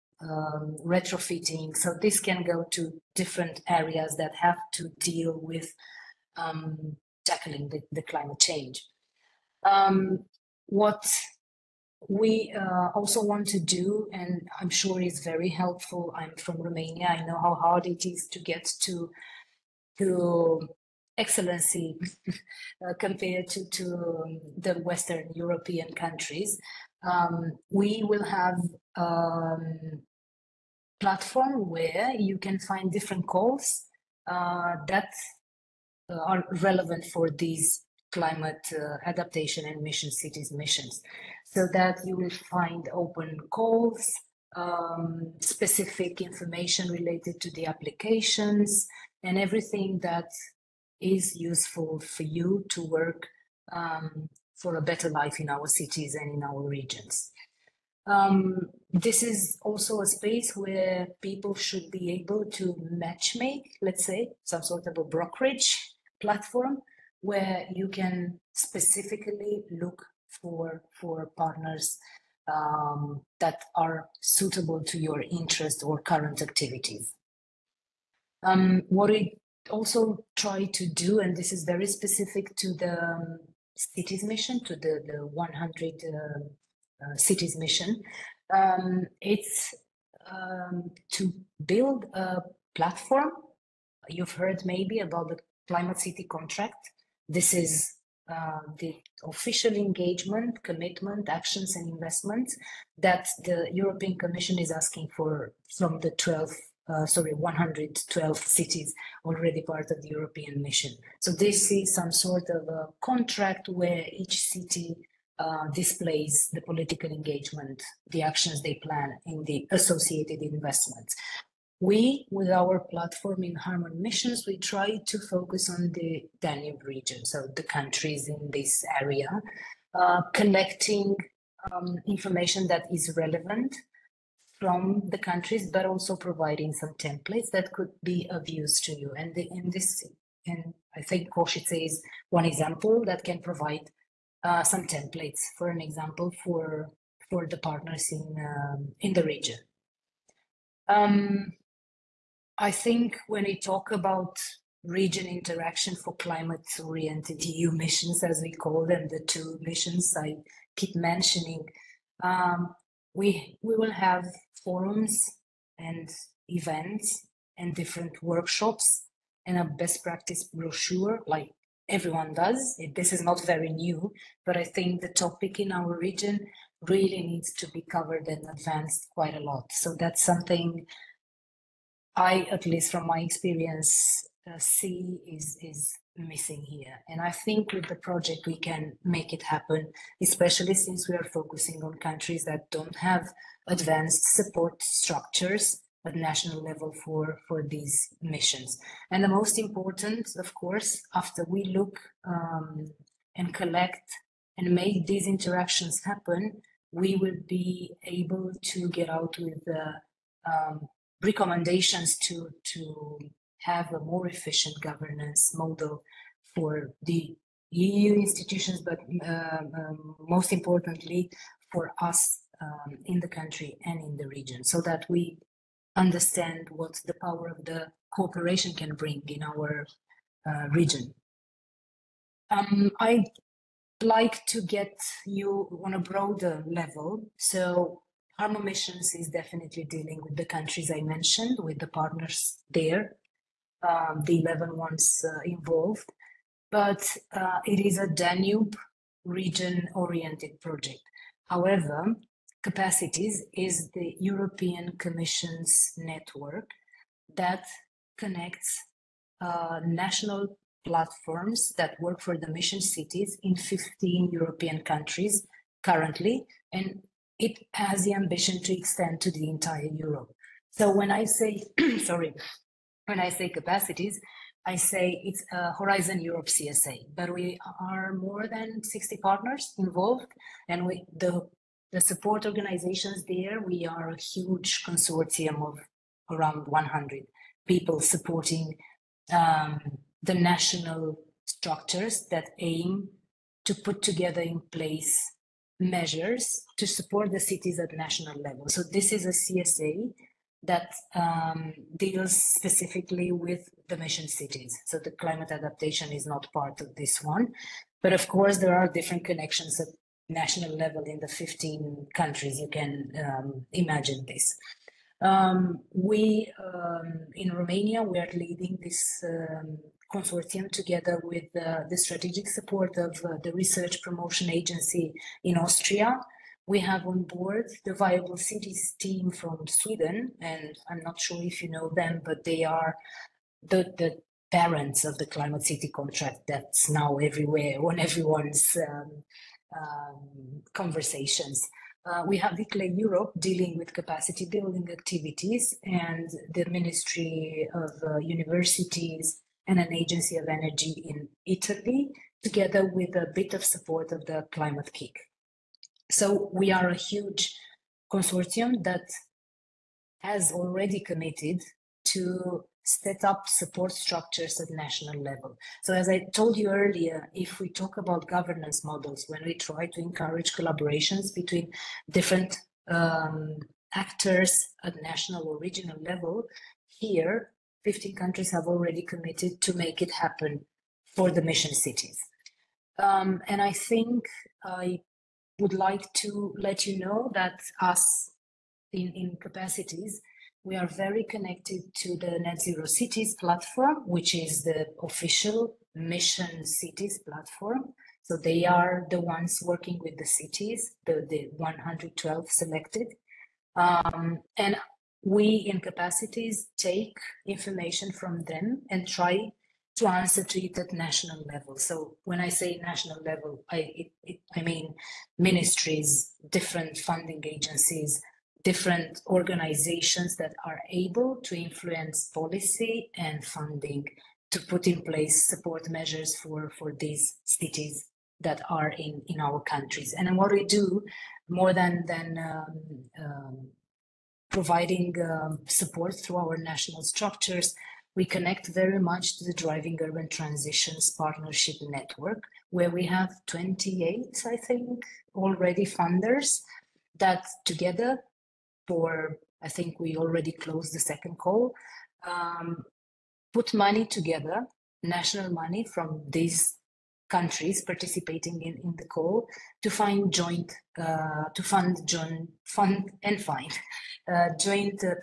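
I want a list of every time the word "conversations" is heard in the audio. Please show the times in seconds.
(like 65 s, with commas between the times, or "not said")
340 s.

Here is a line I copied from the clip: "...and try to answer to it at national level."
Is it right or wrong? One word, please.
right.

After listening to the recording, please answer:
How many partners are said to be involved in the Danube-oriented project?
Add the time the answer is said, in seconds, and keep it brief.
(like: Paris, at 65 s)
11, at 244 s.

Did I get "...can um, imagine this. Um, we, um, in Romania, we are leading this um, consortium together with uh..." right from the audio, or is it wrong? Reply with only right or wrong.
right.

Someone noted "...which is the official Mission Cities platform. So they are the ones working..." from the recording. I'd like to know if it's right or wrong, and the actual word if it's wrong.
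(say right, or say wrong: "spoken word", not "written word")
right.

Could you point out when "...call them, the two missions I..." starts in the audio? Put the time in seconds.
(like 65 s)
158 s.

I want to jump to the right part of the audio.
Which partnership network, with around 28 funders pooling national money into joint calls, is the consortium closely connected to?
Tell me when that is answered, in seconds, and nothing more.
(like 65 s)
439 s.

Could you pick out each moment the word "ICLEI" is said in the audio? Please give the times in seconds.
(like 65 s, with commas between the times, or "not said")
342 s.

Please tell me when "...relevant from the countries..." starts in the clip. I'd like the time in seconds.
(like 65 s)
133 s.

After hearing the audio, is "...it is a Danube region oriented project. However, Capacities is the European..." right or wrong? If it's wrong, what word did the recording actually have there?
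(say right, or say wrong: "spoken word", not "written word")
right.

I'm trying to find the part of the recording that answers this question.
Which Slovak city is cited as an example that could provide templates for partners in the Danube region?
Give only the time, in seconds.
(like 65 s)
141 s.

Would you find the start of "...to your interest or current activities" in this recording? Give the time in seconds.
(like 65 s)
74 s.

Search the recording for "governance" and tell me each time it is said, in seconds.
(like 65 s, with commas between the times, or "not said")
214 s, 368 s.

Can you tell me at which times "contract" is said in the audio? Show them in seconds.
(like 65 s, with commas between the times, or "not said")
96 s, 113 s, 335 s.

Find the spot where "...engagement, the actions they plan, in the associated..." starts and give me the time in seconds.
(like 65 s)
117 s.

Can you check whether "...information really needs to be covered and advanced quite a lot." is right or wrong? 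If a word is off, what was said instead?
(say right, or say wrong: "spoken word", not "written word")
wrong: "region", not "information".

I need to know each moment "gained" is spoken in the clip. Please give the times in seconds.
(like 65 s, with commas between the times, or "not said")
not said.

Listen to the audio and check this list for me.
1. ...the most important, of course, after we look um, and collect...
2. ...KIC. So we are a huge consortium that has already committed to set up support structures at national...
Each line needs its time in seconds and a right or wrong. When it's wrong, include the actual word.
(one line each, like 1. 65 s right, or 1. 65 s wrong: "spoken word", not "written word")
1. 199 s right
2. 354 s right.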